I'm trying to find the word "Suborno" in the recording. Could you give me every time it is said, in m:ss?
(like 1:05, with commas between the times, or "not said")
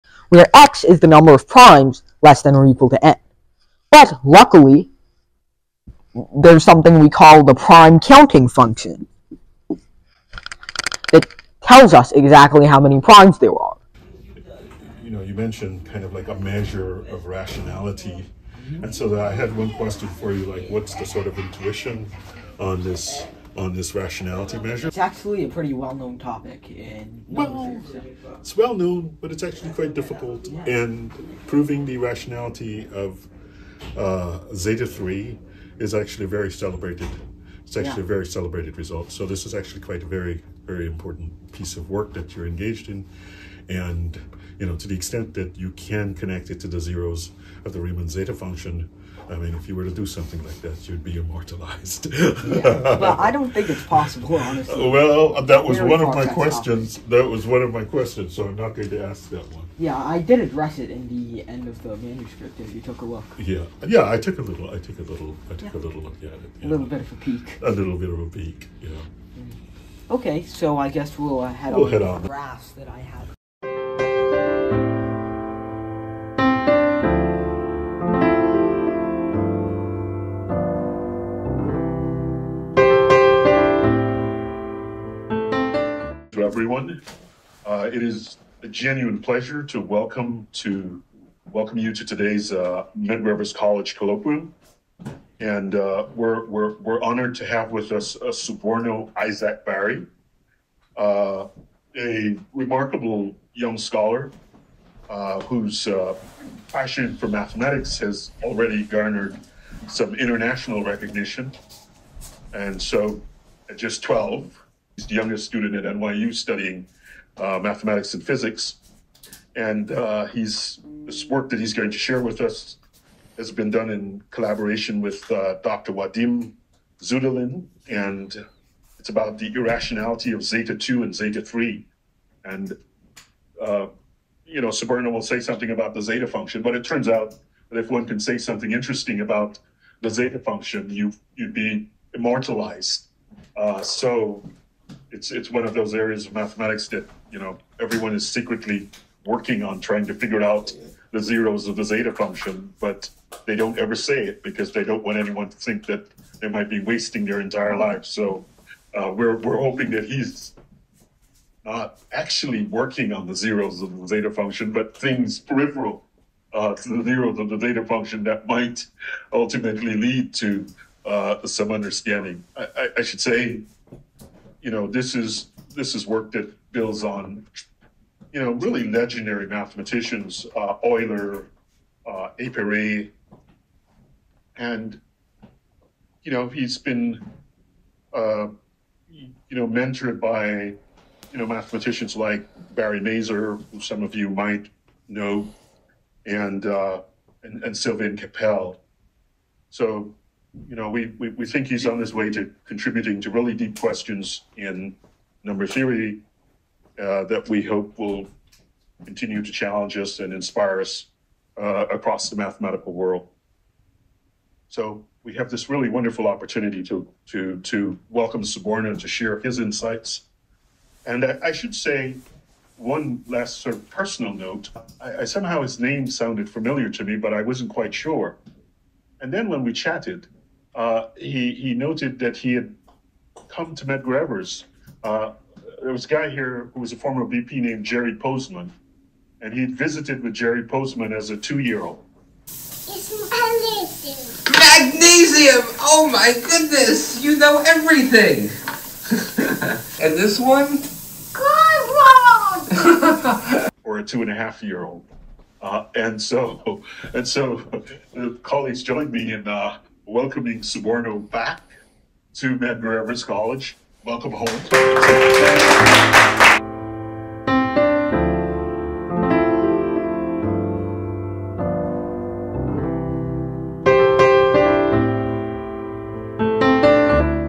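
1:38, 2:14, 3:38, 4:20.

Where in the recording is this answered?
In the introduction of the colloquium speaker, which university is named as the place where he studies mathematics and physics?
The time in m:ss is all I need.
1:55.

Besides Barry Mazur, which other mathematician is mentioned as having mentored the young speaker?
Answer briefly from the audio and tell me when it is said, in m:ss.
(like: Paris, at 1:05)
Sylvain Cappell, at 3:17.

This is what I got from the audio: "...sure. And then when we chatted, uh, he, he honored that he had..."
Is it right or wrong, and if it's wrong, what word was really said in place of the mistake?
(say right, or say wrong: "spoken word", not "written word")
wrong: "noted", not "honored".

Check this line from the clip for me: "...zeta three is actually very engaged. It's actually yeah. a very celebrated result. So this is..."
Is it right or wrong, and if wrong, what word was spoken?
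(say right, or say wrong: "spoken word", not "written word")
wrong: "celebrated", not "engaged".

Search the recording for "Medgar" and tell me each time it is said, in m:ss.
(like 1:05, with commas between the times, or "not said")
1:32, 3:53, 4:22.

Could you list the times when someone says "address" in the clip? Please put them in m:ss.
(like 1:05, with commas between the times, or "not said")
1:00.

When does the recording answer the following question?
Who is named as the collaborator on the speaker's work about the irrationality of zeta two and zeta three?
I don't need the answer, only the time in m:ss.
2:05.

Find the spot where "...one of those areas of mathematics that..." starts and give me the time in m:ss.
2:25.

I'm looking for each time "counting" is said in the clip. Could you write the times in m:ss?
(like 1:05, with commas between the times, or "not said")
0:07.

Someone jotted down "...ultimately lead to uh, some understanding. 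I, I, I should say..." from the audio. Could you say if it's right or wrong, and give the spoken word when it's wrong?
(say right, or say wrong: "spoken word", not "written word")
right.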